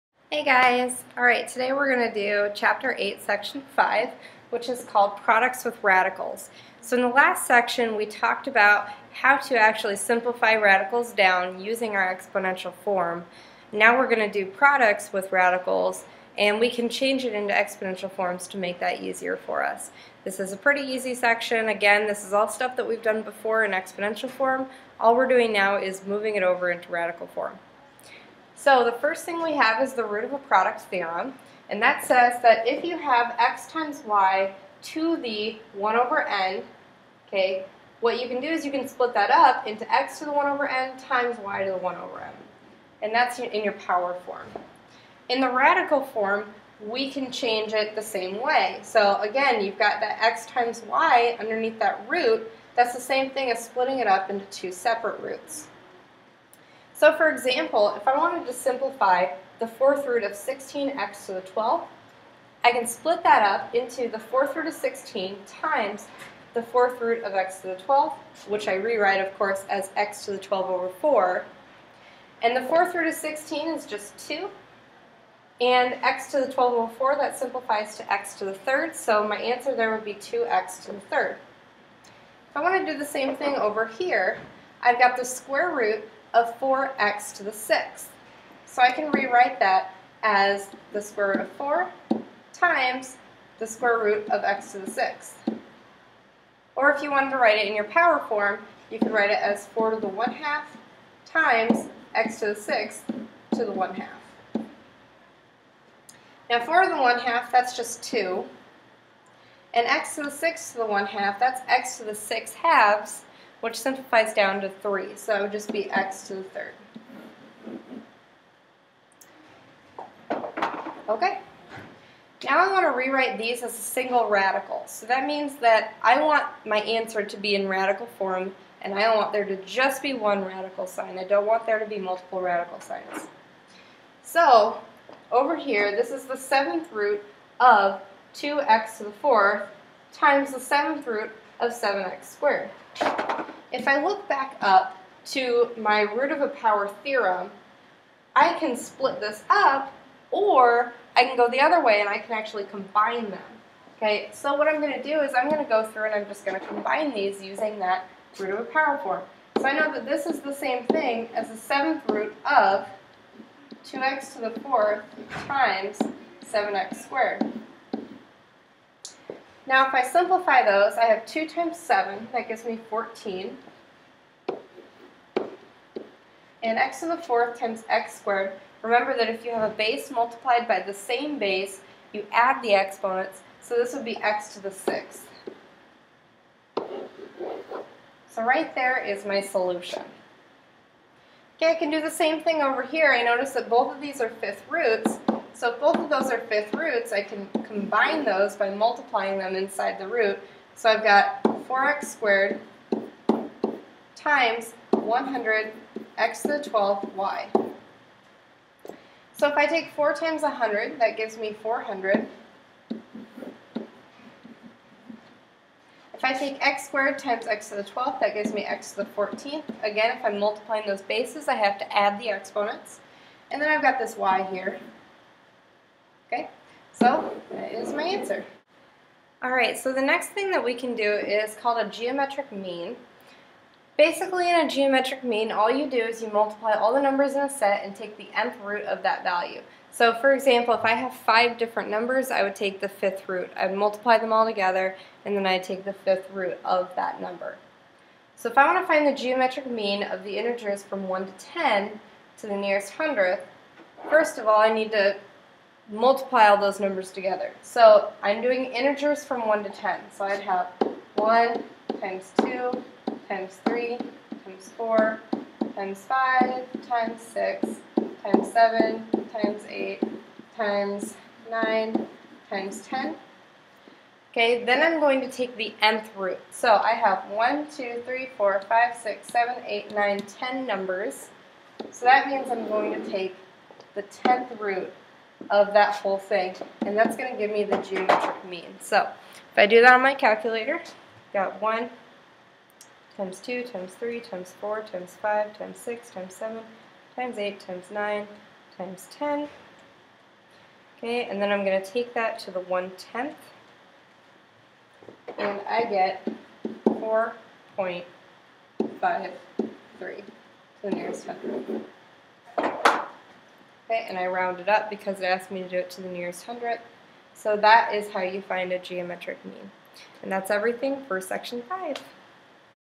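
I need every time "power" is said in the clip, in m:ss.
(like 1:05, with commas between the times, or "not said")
0:43, 1:37, 2:26, 2:38.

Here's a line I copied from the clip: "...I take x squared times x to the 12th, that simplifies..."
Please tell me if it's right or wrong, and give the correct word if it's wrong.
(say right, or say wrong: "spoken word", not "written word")
wrong: "gives", not "simplifies".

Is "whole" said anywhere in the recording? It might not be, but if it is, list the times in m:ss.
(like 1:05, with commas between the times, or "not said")
4:45.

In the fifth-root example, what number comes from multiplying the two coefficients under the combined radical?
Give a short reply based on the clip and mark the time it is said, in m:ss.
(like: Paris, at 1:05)
400, at 3:31.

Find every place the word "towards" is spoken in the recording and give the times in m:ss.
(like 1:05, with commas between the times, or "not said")
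not said.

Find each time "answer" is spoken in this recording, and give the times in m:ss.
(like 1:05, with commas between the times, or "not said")
1:19, 2:06, 3:48.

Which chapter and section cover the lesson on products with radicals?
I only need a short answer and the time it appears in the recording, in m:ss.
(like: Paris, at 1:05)
Chapter 8, Section 5, at 0:02.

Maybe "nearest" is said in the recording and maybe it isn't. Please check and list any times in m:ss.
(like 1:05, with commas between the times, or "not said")
4:12, 5:10, 5:16.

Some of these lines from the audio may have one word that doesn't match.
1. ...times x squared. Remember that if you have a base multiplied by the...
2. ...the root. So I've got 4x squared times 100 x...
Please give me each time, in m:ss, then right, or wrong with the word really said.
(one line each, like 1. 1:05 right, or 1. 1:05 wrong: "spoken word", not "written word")
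1. 2:57 right
2. 3:19 right.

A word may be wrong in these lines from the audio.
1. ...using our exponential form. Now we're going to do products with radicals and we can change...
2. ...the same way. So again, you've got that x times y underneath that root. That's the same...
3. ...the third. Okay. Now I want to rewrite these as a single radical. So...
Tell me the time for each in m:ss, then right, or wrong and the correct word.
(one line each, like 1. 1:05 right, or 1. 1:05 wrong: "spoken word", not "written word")
1. 0:11 right
2. 0:47 right
3. 1:56 right.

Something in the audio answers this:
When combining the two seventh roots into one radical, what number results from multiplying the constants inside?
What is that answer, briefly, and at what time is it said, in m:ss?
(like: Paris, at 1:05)
14, at 2:52.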